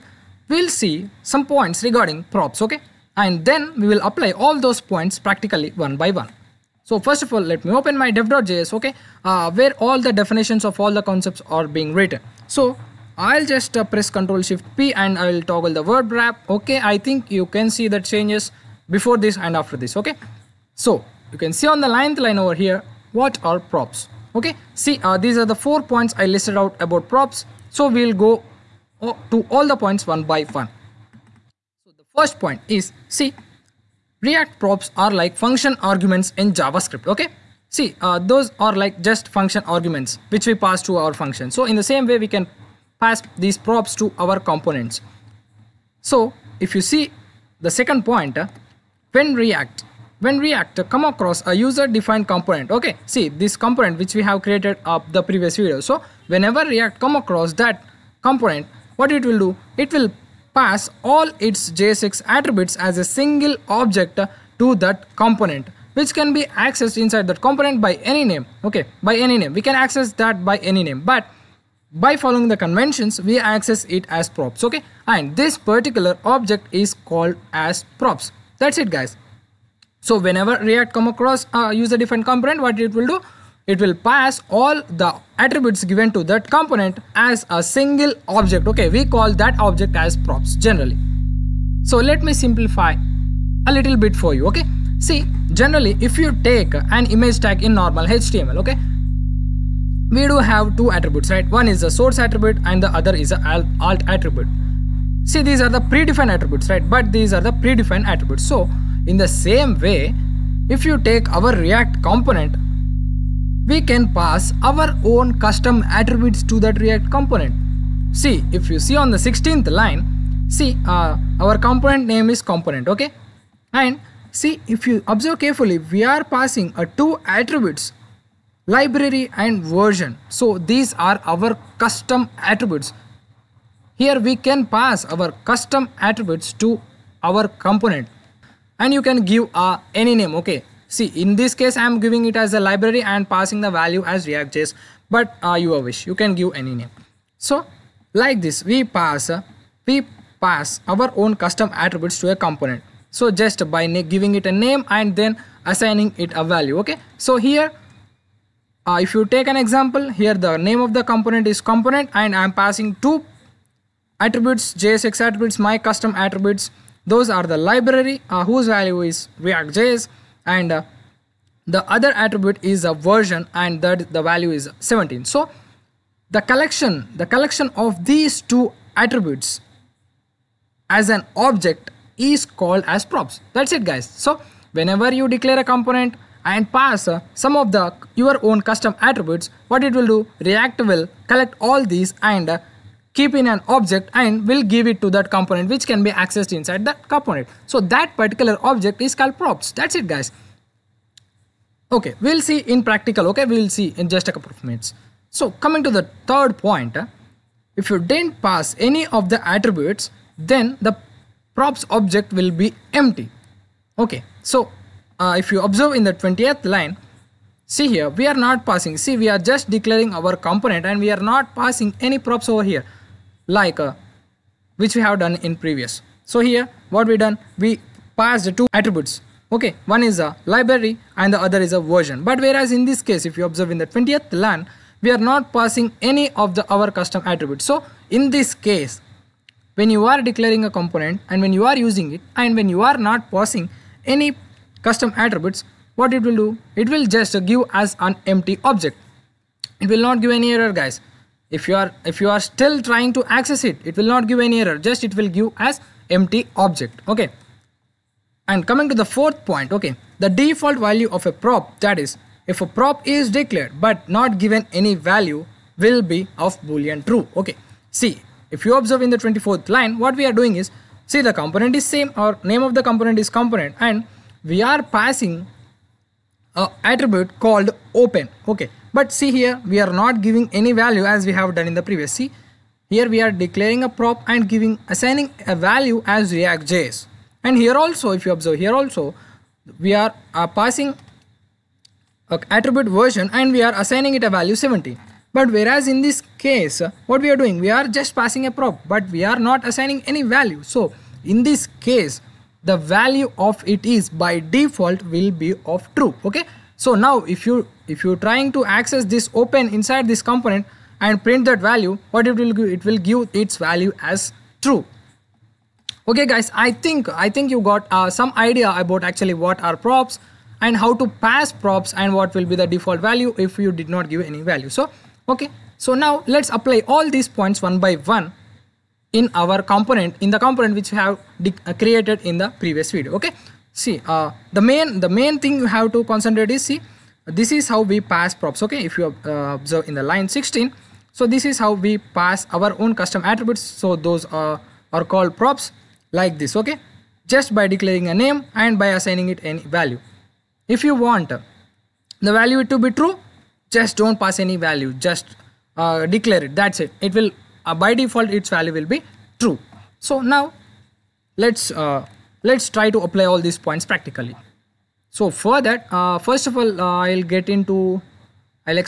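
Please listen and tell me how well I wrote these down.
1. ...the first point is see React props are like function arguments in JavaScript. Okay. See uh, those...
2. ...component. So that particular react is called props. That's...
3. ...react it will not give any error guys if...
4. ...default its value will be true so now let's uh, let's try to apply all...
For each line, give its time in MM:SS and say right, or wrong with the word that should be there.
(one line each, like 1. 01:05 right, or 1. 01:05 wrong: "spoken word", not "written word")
1. 00:31 right
2. 03:17 wrong: "object", not "react"
3. 04:08 wrong: "object", not "react"
4. 05:58 right.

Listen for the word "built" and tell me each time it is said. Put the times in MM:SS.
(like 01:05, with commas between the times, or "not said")
not said.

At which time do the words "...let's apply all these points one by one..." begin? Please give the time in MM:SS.
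05:26.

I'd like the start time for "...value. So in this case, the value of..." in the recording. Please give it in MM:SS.
05:00.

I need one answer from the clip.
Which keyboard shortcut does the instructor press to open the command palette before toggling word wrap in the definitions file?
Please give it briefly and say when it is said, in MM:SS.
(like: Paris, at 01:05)
Control Shift P, at 00:14.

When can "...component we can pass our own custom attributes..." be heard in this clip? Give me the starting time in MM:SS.
01:52.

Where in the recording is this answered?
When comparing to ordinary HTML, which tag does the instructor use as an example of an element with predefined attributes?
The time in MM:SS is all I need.
01:37.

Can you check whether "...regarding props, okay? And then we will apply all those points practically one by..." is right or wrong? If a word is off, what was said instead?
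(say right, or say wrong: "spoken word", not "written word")
right.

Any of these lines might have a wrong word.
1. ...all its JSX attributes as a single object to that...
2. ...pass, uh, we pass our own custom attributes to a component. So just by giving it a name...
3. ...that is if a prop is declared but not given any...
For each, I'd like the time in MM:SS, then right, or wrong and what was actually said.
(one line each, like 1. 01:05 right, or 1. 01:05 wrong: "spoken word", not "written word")
1. 01:01 right
2. 02:28 right
3. 04:21 right.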